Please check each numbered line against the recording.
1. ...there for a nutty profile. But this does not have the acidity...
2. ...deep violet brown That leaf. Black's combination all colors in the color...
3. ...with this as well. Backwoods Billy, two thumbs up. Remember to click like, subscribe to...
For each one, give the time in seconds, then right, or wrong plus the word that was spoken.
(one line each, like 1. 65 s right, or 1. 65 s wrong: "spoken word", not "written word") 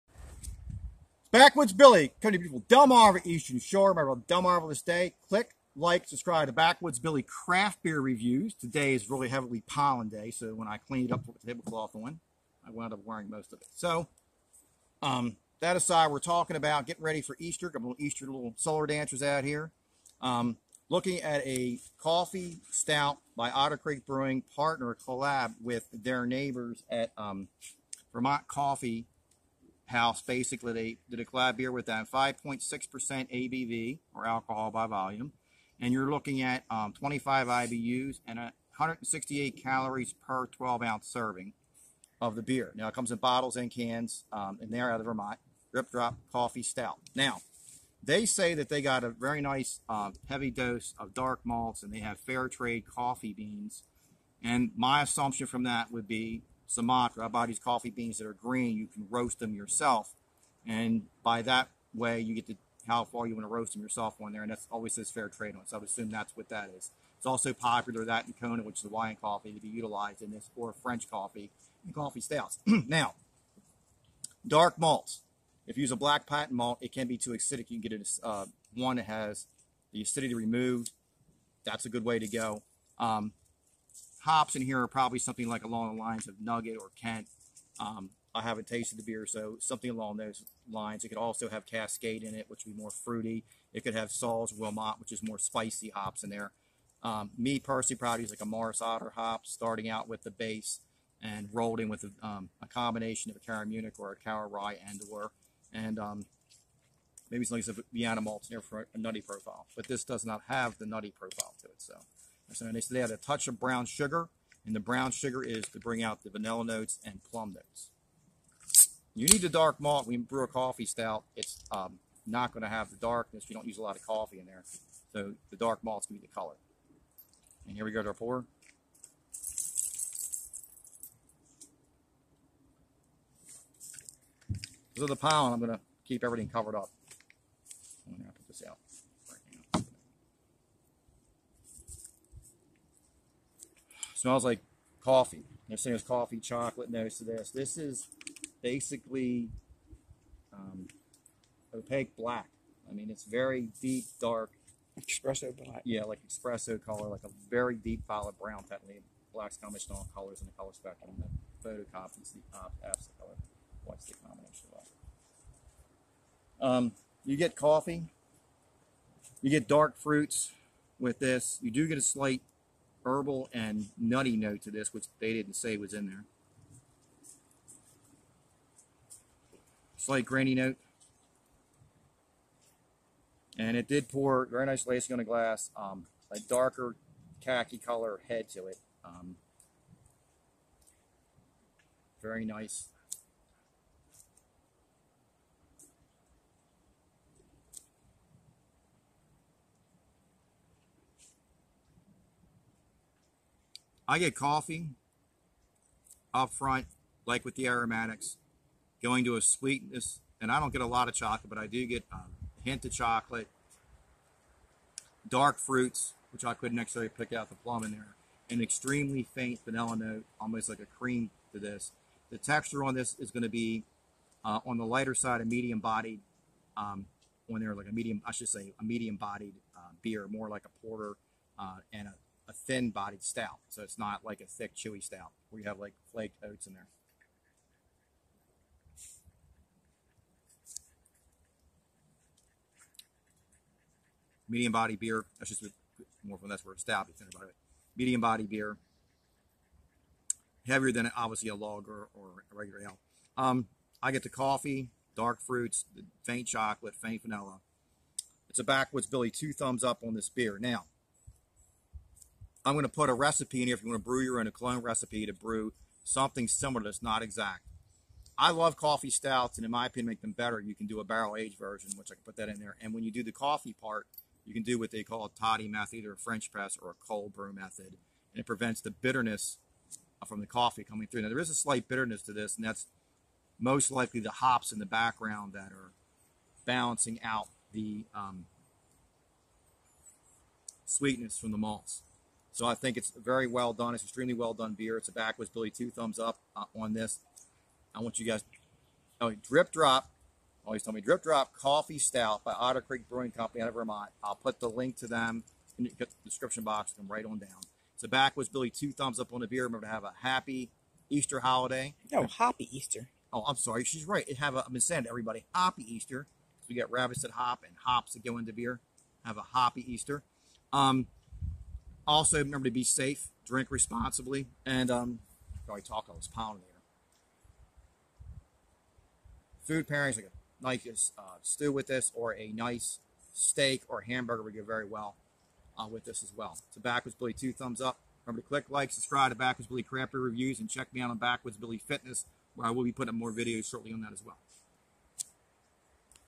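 1. 108 s wrong: "nutty", not "acidity"
2. 157 s right
3. 335 s right.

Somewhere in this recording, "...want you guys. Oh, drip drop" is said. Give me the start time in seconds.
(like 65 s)
298 s.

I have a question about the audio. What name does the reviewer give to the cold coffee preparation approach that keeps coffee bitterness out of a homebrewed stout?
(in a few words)
Toddy method.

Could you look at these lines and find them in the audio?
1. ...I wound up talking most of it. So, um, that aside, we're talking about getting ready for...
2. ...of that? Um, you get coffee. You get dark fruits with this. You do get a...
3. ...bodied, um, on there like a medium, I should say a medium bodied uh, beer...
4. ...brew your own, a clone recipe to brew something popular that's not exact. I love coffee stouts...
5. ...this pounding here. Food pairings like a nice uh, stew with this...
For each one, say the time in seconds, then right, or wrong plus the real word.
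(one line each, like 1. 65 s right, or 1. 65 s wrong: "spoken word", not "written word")
1. 12 s wrong: "wearing", not "talking"
2. 164 s right
3. 225 s right
4. 264 s wrong: "similar", not "popular"
5. 326 s right.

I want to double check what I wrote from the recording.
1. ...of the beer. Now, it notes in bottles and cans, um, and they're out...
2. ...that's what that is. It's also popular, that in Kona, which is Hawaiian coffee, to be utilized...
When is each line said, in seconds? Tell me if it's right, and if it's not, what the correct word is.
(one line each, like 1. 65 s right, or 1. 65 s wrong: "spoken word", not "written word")
1. 42 s wrong: "comes", not "notes"
2. 66 s right.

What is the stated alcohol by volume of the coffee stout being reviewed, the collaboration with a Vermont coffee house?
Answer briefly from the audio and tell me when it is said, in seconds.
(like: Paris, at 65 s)
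5.6%, at 32 s.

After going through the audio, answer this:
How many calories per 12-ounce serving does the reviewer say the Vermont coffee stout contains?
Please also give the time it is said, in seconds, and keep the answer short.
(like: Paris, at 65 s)
168, at 38 s.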